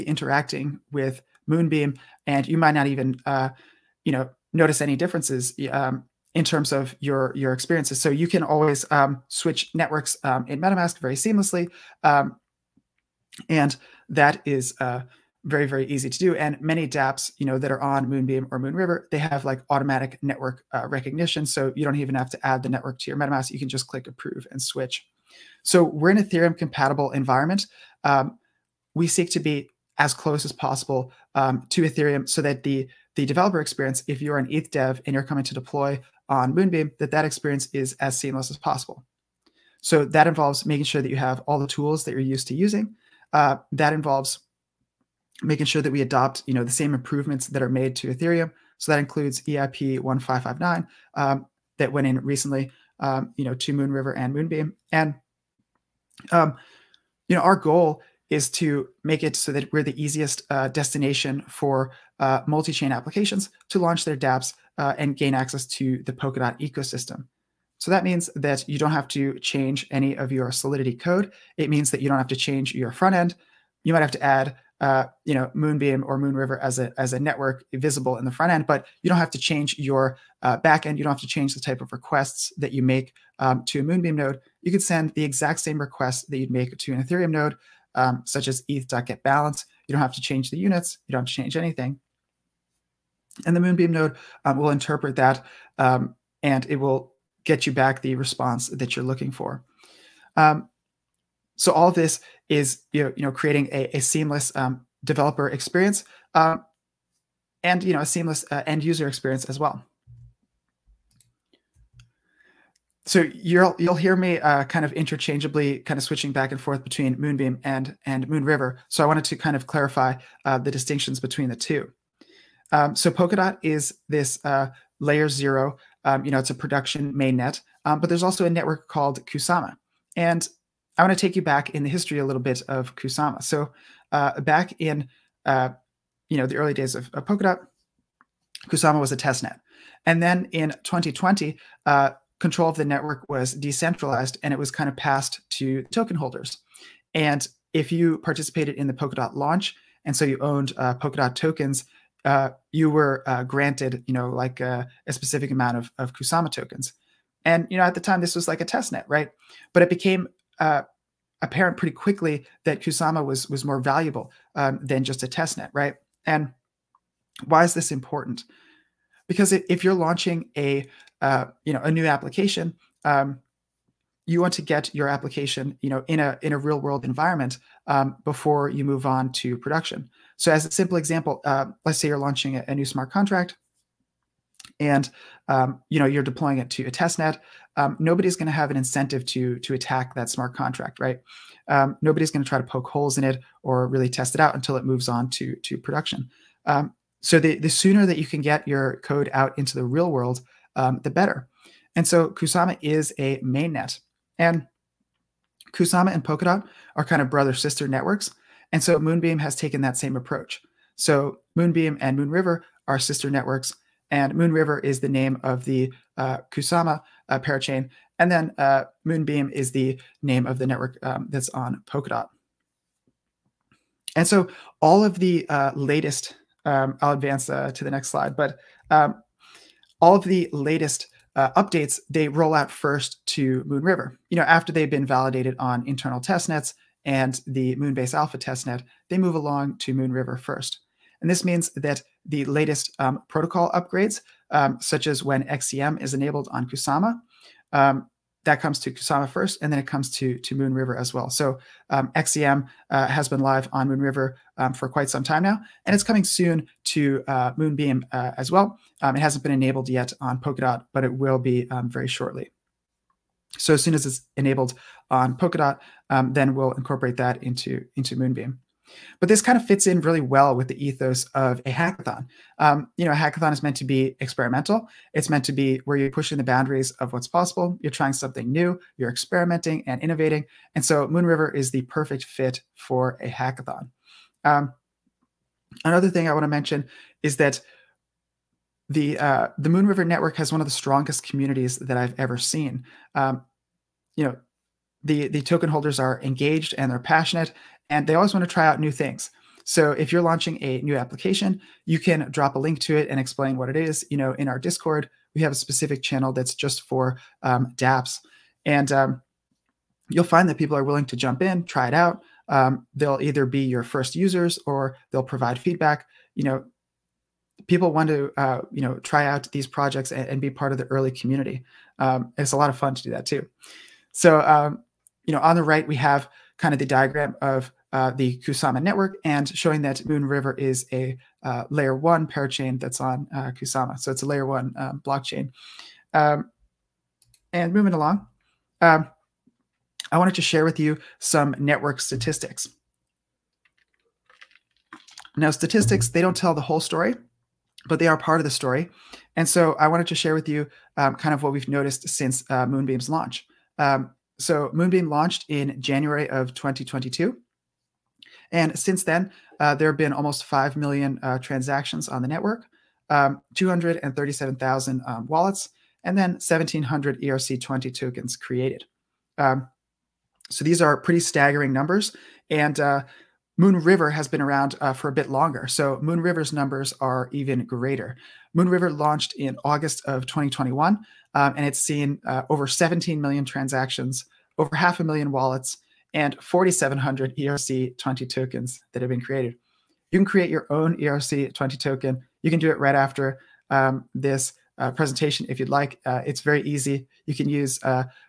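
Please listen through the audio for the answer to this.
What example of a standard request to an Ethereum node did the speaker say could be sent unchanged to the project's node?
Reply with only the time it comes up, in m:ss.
1:28.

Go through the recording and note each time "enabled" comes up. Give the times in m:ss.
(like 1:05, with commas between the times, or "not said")
4:06, 4:19, 4:24.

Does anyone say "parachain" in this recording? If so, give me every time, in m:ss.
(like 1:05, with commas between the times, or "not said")
3:37, 5:32.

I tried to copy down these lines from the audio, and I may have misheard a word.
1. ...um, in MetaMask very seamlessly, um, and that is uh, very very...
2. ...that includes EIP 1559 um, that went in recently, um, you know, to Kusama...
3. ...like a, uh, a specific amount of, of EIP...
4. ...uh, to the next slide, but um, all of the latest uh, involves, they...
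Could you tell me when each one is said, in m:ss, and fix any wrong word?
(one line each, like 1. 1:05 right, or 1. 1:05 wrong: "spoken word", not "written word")
1. 0:10 right
2. 0:48 wrong: "Moonriver", not "Kusama"
3. 2:34 wrong: "Kusama", not "EIP"
4. 3:47 wrong: "updates", not "involves".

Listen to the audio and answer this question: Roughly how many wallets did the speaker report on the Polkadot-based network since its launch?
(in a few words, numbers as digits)
237,000.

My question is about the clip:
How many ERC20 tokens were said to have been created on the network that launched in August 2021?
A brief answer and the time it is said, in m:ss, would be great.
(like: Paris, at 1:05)
4,700, at 6:26.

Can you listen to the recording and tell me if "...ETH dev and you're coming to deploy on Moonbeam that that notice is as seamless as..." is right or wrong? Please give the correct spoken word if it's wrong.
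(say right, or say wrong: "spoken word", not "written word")
wrong: "experience", not "notice".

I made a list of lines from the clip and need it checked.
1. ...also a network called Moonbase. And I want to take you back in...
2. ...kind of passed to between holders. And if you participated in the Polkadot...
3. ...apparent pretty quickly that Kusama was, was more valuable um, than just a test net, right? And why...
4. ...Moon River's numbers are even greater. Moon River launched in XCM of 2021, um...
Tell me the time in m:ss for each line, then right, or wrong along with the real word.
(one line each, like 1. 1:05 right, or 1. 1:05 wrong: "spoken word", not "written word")
1. 2:08 wrong: "Kusama", not "Moonbase"
2. 2:24 wrong: "token", not "between"
3. 2:41 right
4. 6:16 wrong: "August", not "XCM".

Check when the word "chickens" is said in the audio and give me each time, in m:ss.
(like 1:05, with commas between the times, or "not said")
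not said.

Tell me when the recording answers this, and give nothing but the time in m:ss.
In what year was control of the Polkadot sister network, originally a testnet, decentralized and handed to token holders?
2:20.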